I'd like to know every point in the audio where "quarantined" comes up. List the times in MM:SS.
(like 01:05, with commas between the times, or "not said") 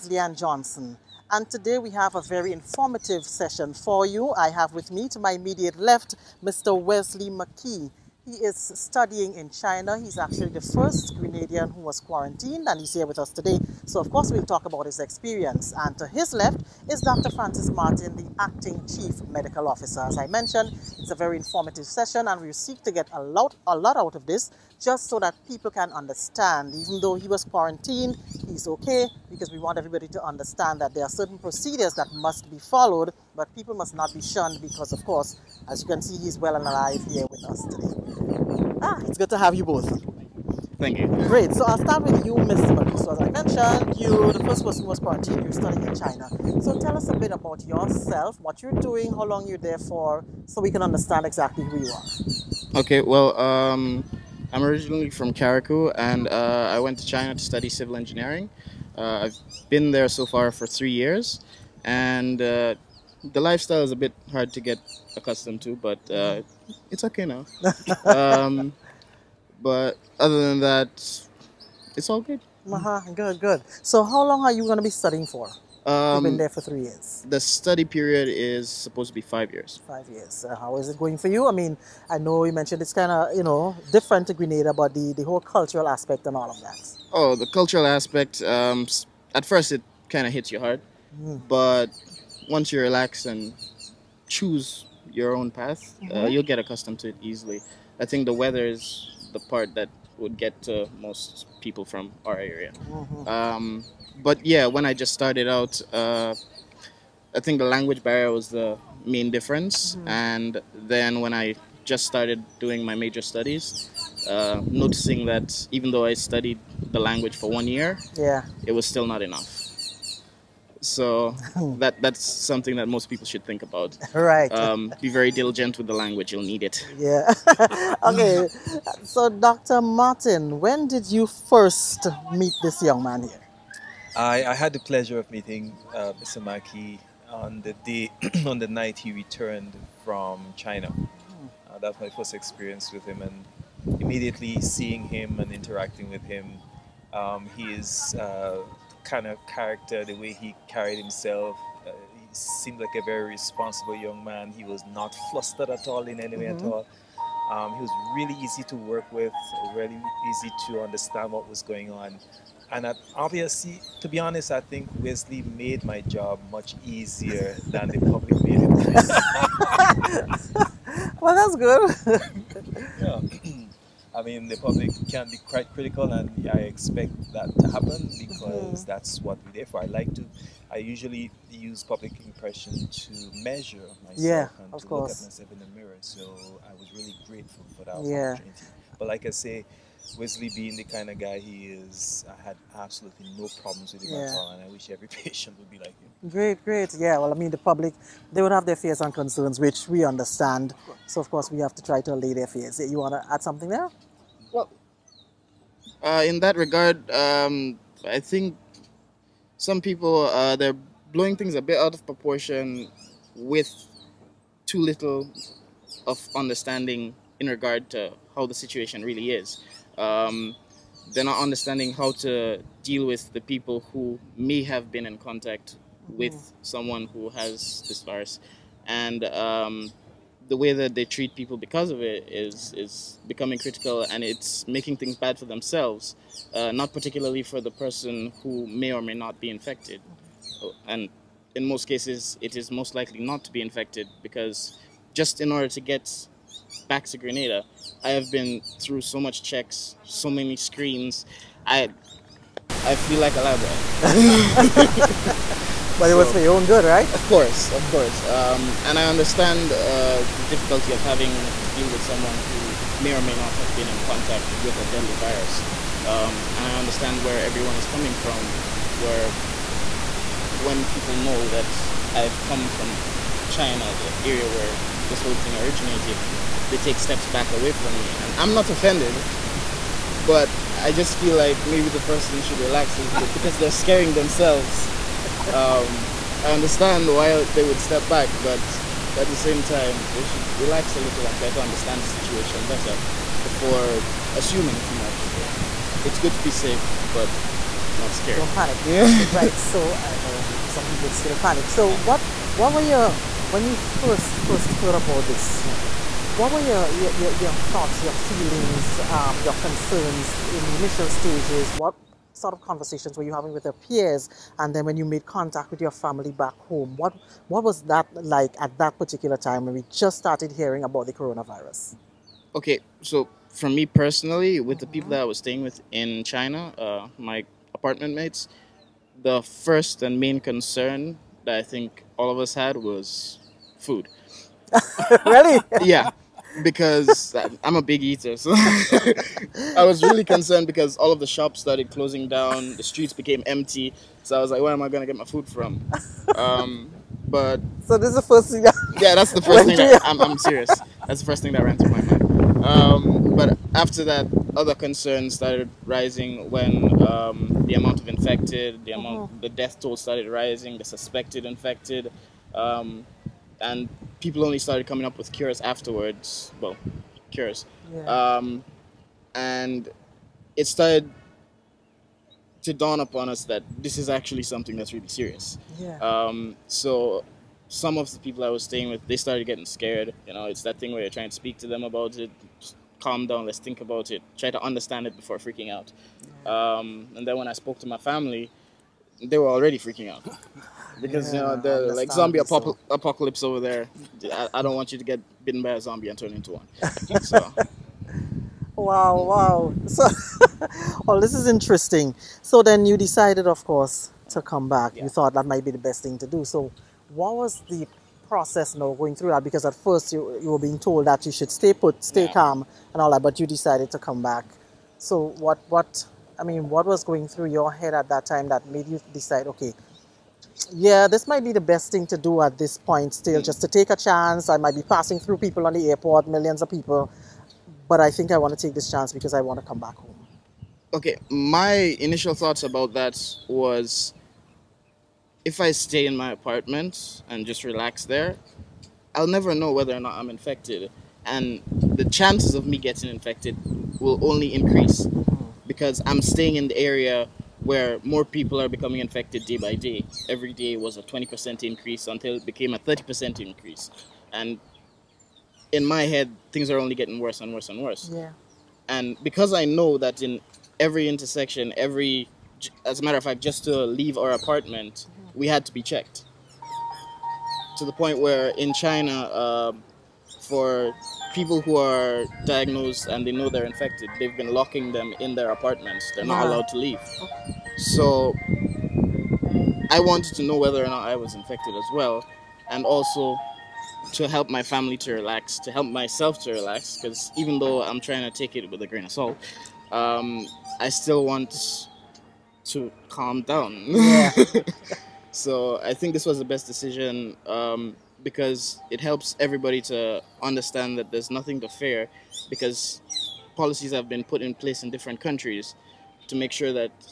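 00:12, 00:27, 00:44.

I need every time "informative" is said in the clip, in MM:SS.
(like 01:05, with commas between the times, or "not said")
00:02, 00:21.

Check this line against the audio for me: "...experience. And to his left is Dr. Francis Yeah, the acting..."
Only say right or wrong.
wrong.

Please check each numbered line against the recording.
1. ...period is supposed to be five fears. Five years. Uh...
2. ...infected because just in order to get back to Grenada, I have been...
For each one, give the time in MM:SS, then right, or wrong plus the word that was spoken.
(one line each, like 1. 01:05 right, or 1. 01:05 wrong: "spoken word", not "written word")
1. 01:17 wrong: "years", not "fears"
2. 04:03 right.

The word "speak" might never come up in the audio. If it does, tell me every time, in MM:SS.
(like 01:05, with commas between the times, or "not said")
06:21.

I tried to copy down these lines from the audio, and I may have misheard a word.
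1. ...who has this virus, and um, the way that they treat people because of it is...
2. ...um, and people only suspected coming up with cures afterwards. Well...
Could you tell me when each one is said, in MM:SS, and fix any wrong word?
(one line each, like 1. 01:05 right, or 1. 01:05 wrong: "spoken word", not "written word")
1. 03:47 right
2. 06:02 wrong: "started", not "suspected".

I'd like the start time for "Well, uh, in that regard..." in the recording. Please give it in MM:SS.
03:24.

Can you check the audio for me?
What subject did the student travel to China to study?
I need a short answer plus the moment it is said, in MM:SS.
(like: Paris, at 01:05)
Civil engineering, at 00:57.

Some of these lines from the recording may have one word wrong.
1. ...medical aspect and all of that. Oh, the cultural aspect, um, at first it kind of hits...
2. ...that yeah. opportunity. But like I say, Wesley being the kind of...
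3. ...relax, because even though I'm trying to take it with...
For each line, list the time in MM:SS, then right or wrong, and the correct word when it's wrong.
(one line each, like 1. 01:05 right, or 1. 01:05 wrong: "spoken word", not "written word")
1. 01:25 wrong: "cultural", not "medical"
2. 03:07 right
3. 08:06 right.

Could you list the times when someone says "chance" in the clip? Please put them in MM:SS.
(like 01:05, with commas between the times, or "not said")
07:03, 07:08, 07:22.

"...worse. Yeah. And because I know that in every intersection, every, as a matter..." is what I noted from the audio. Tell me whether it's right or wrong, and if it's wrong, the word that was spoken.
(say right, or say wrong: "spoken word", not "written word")
right.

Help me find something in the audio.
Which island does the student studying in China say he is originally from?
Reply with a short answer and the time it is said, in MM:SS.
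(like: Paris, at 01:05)
Carriacou, at 00:55.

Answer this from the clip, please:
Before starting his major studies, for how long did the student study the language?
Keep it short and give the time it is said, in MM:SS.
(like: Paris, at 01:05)
1 year, at 01:57.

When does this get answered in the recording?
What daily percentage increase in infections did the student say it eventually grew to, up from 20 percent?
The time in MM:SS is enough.
07:32.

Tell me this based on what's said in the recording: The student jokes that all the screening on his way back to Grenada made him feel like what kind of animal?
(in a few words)
A lab rat.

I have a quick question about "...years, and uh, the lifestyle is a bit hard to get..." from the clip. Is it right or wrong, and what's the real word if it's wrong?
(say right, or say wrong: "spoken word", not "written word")
right.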